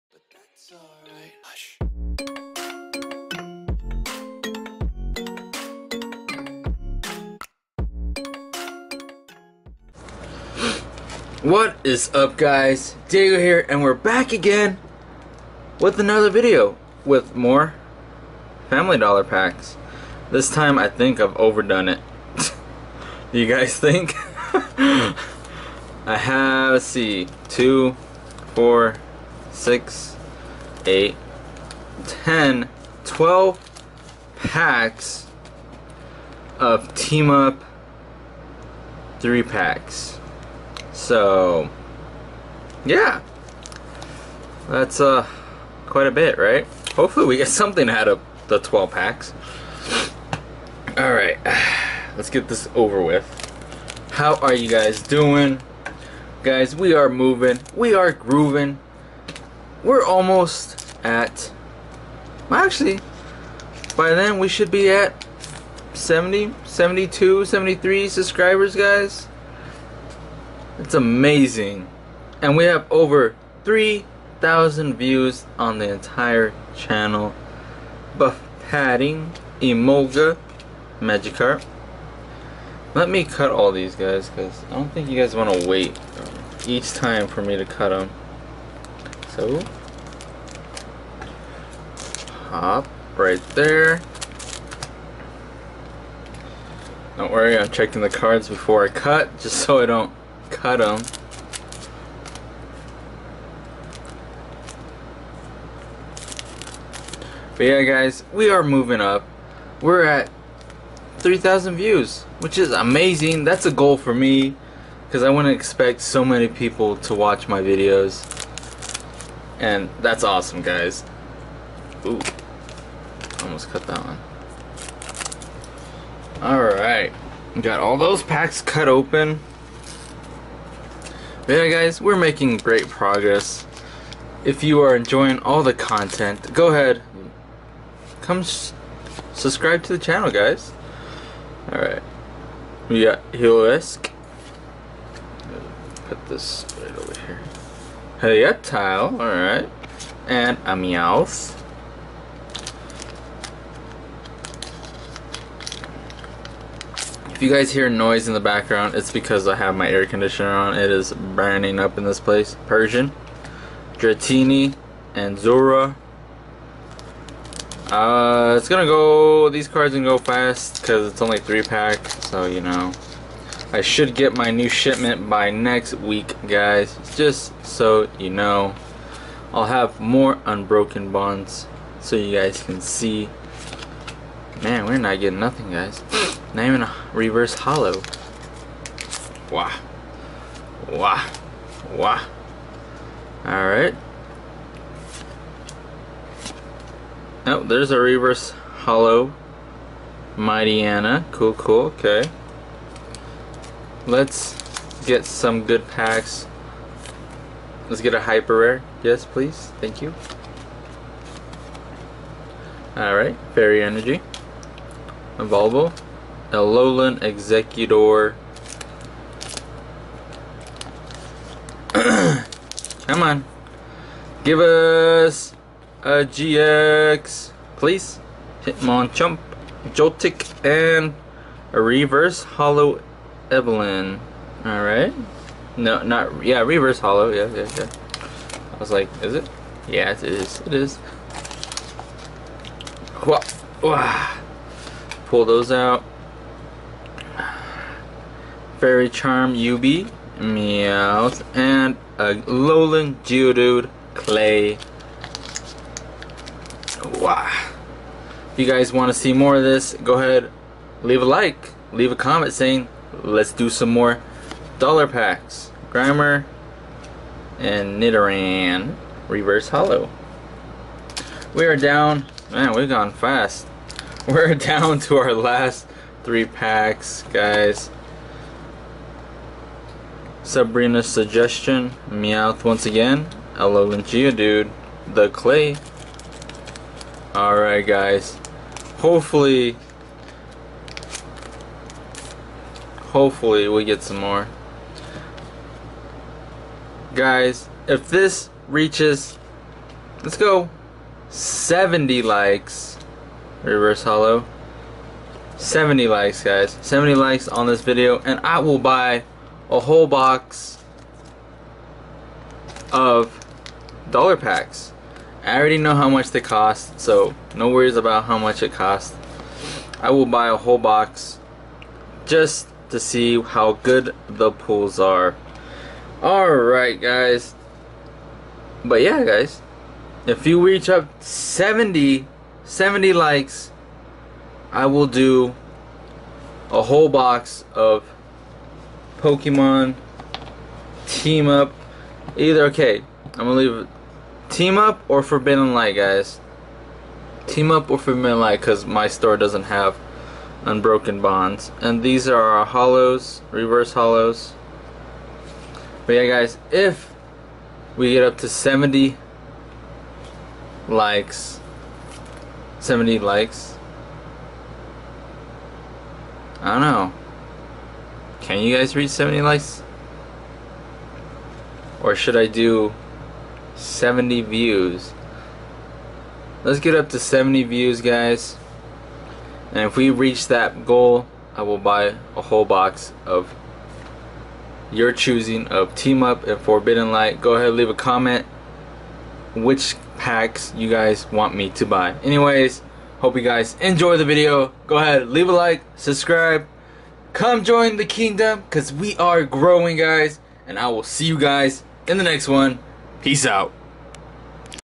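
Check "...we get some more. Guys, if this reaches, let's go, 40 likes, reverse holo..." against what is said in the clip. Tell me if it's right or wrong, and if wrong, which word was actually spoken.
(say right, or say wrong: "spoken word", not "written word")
wrong: "70", not "40".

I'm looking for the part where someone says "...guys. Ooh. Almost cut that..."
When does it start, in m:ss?
2:00.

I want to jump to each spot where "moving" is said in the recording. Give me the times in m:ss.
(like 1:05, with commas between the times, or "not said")
0:57, 1:48.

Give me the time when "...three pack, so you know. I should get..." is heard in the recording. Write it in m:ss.
2:51.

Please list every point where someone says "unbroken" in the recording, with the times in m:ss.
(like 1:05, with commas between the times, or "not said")
3:00, 5:50.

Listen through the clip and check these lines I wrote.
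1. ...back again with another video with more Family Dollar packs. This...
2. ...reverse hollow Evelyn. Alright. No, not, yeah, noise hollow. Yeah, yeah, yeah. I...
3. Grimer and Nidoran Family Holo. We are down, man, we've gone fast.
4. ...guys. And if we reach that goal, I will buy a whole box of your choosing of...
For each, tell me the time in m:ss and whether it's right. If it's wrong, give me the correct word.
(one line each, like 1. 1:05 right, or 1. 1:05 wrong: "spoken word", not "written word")
1. 0:13 right
2. 3:51 wrong: "reverse", not "noise"
3. 4:25 wrong: "Reverse", not "Family"
4. 6:18 right.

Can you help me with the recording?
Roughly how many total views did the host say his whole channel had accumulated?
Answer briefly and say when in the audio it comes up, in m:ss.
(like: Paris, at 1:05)
3,000, at 1:12.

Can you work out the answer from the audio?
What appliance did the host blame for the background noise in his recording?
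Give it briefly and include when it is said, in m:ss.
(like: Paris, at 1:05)
air conditioner, at 2:39.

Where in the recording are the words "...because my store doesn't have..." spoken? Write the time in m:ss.
5:48.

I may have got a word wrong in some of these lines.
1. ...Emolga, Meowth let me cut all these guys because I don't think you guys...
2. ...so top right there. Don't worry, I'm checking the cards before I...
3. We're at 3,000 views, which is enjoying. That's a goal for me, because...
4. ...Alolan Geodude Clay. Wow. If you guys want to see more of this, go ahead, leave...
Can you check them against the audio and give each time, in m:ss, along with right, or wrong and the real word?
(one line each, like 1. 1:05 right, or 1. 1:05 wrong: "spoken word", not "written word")
1. 1:19 wrong: "Magikarp", not "Meowth"
2. 1:29 right
3. 1:49 wrong: "amazing", not "enjoying"
4. 4:12 right.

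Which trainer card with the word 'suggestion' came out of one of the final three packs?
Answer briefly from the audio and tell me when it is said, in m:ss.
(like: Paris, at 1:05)
Sabrina's Suggestion, at 4:40.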